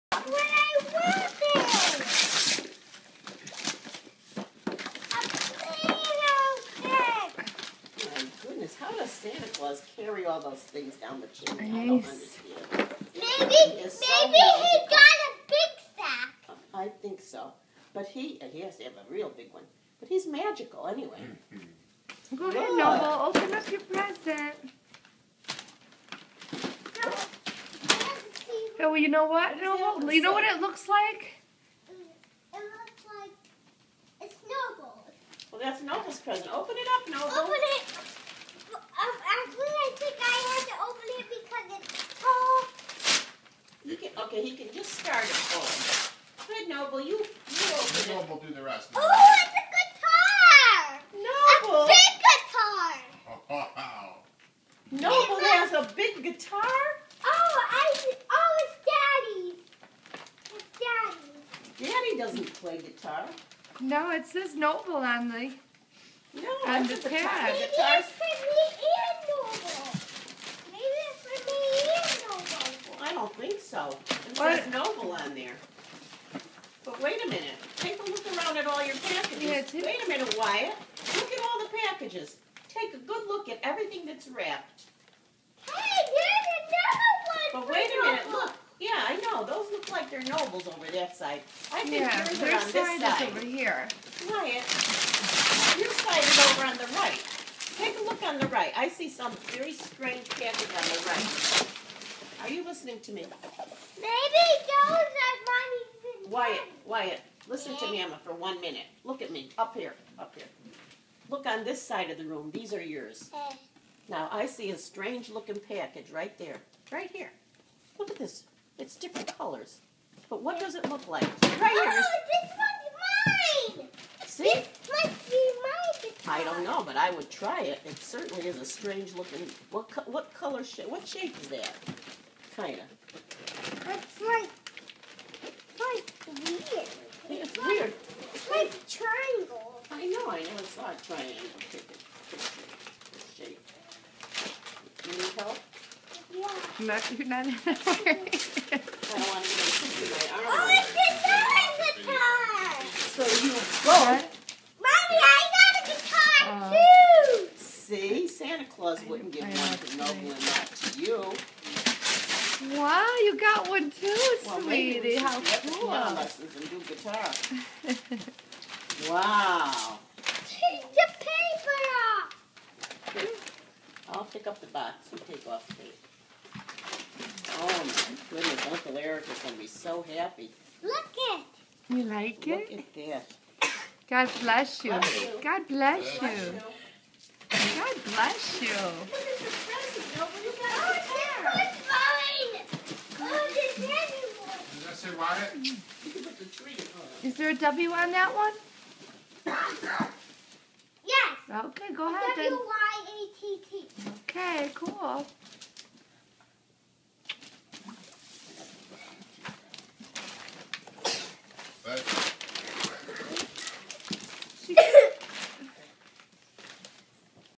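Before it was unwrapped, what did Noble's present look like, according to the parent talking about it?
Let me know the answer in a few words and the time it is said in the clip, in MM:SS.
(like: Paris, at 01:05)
snowball, at 00:34.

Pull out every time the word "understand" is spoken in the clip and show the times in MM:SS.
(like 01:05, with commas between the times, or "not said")
00:12.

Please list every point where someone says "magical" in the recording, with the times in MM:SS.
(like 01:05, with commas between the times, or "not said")
00:20.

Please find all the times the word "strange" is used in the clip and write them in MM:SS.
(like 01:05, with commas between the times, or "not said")
01:39, 01:54, 02:08.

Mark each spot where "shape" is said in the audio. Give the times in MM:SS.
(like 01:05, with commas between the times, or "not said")
02:11, 02:23.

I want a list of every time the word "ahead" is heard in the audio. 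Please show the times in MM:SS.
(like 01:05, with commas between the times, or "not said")
00:22, 03:22.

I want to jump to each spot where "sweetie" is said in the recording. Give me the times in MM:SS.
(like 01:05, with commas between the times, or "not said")
02:44.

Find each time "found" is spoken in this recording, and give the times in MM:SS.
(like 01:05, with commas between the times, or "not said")
not said.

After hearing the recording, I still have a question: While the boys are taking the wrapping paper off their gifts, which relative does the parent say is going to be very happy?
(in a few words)
Uncle Eric.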